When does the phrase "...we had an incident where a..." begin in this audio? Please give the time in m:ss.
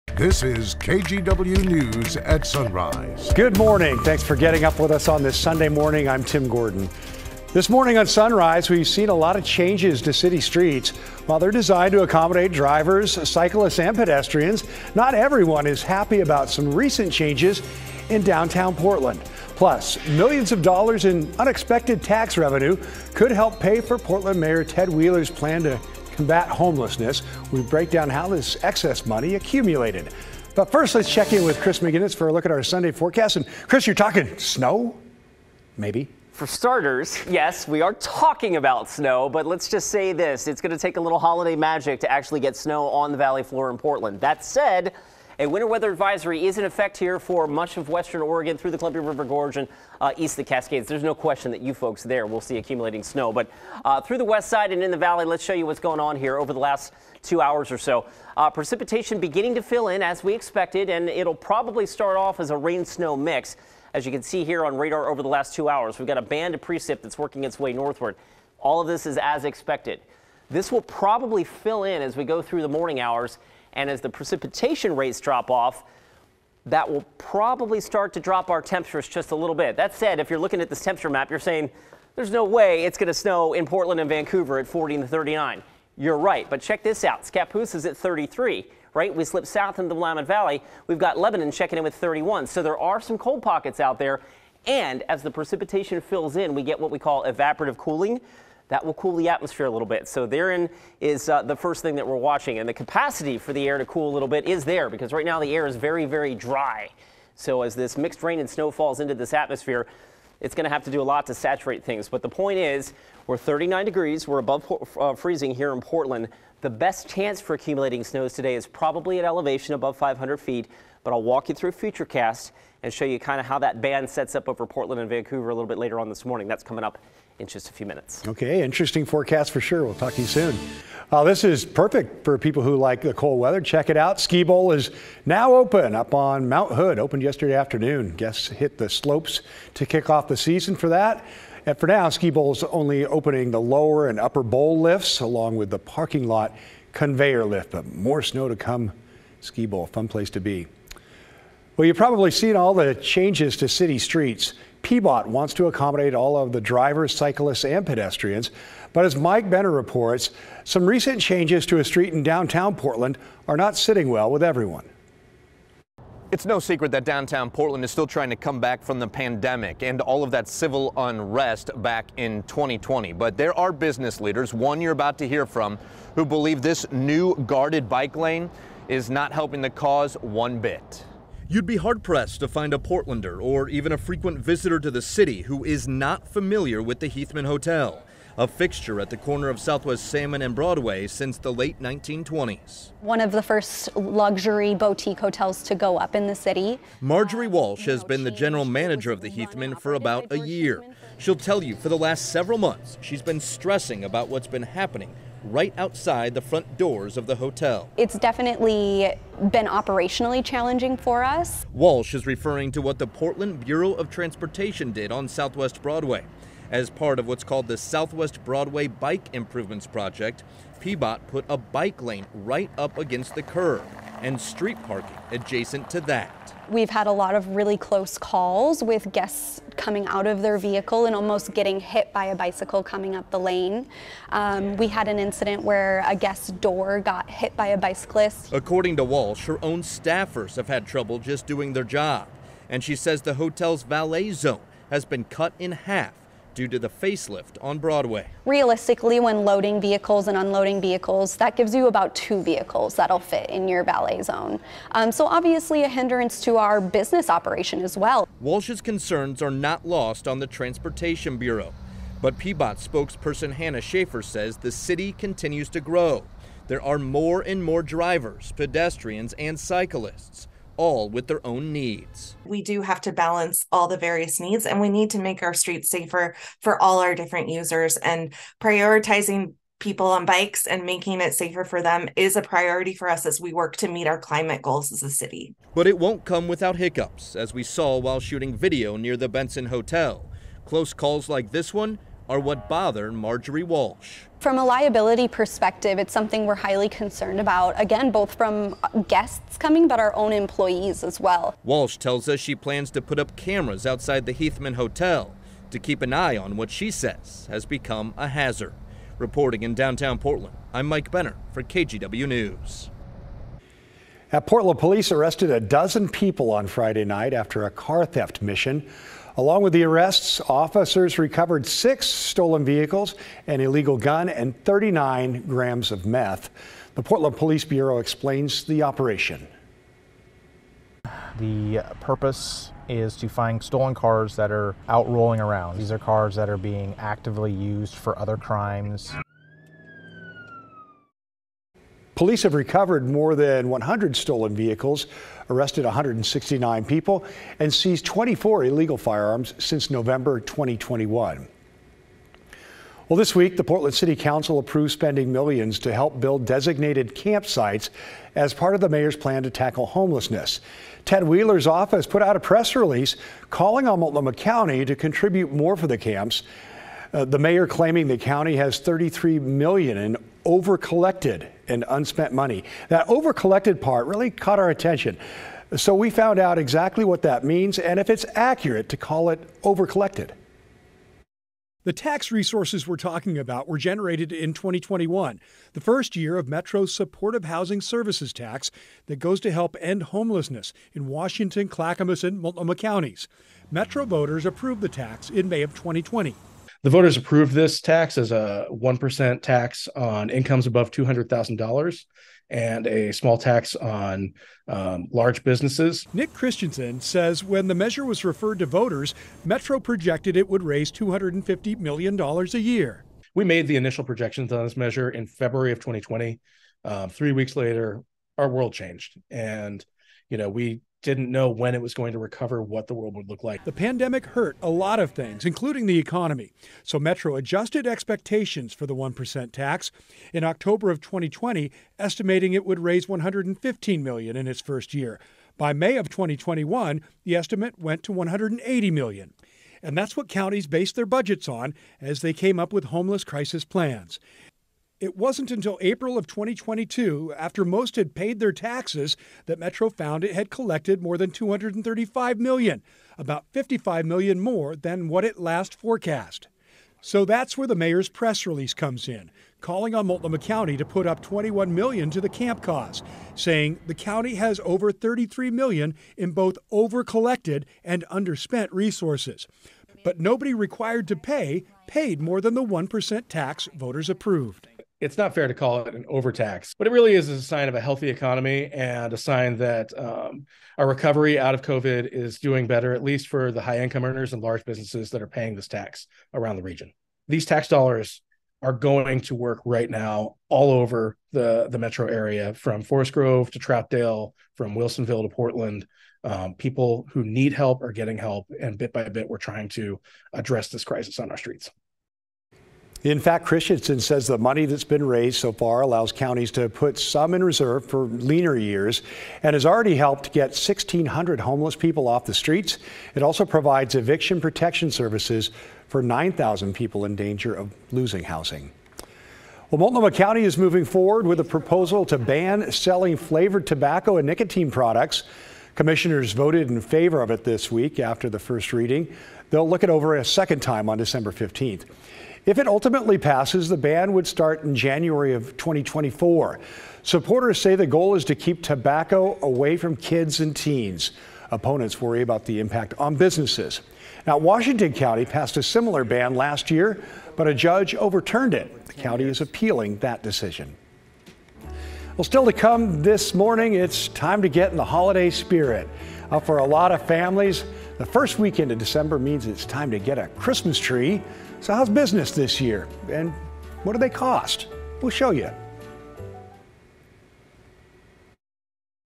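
3:54.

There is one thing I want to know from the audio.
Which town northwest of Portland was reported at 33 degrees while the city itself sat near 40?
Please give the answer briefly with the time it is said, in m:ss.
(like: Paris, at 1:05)
Scappoose, at 1:27.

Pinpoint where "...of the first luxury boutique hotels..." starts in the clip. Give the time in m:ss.
3:13.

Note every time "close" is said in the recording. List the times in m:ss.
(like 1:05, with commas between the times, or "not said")
3:47, 4:50.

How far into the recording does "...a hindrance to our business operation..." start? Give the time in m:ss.
4:15.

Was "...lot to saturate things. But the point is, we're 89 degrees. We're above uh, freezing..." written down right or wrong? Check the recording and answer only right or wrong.
wrong.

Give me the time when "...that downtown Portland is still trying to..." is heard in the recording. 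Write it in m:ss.
2:46.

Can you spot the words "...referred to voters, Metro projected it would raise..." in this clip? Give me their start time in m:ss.
6:48.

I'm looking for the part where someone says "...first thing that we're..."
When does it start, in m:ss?
1:41.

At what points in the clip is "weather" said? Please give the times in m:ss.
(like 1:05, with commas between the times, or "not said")
0:45, 2:13.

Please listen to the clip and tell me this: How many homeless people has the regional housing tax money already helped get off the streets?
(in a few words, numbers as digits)
1,600.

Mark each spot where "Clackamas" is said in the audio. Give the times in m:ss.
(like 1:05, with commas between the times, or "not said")
6:31.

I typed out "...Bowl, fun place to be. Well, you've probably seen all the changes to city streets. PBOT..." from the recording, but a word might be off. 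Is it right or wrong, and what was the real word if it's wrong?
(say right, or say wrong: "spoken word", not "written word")
right.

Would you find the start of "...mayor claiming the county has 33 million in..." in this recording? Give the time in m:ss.
6:07.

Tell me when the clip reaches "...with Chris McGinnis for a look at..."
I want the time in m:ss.
0:31.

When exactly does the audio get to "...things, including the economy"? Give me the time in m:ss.
7:05.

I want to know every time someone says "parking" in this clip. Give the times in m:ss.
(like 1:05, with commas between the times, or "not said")
2:25, 3:44.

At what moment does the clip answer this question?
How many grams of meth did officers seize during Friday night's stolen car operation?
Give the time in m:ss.
5:24.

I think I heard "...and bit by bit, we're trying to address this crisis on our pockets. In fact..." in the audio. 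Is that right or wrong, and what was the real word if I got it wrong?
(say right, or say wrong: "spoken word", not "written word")
wrong: "streets", not "pockets".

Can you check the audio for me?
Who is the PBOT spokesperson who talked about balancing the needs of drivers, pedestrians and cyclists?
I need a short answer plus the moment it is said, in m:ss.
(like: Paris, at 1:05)
Hannah Schaefer, at 4:23.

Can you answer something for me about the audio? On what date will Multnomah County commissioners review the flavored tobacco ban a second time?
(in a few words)
December 15.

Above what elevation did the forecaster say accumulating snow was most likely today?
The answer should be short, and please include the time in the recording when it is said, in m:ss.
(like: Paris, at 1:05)
500 feet, at 1:59.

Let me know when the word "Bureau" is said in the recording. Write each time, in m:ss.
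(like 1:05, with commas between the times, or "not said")
3:33, 4:21, 5:27.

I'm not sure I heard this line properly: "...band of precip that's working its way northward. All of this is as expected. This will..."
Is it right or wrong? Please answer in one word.
right.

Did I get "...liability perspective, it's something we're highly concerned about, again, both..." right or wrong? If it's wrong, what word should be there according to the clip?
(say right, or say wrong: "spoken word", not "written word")
right.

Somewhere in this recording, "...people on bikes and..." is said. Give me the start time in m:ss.
4:39.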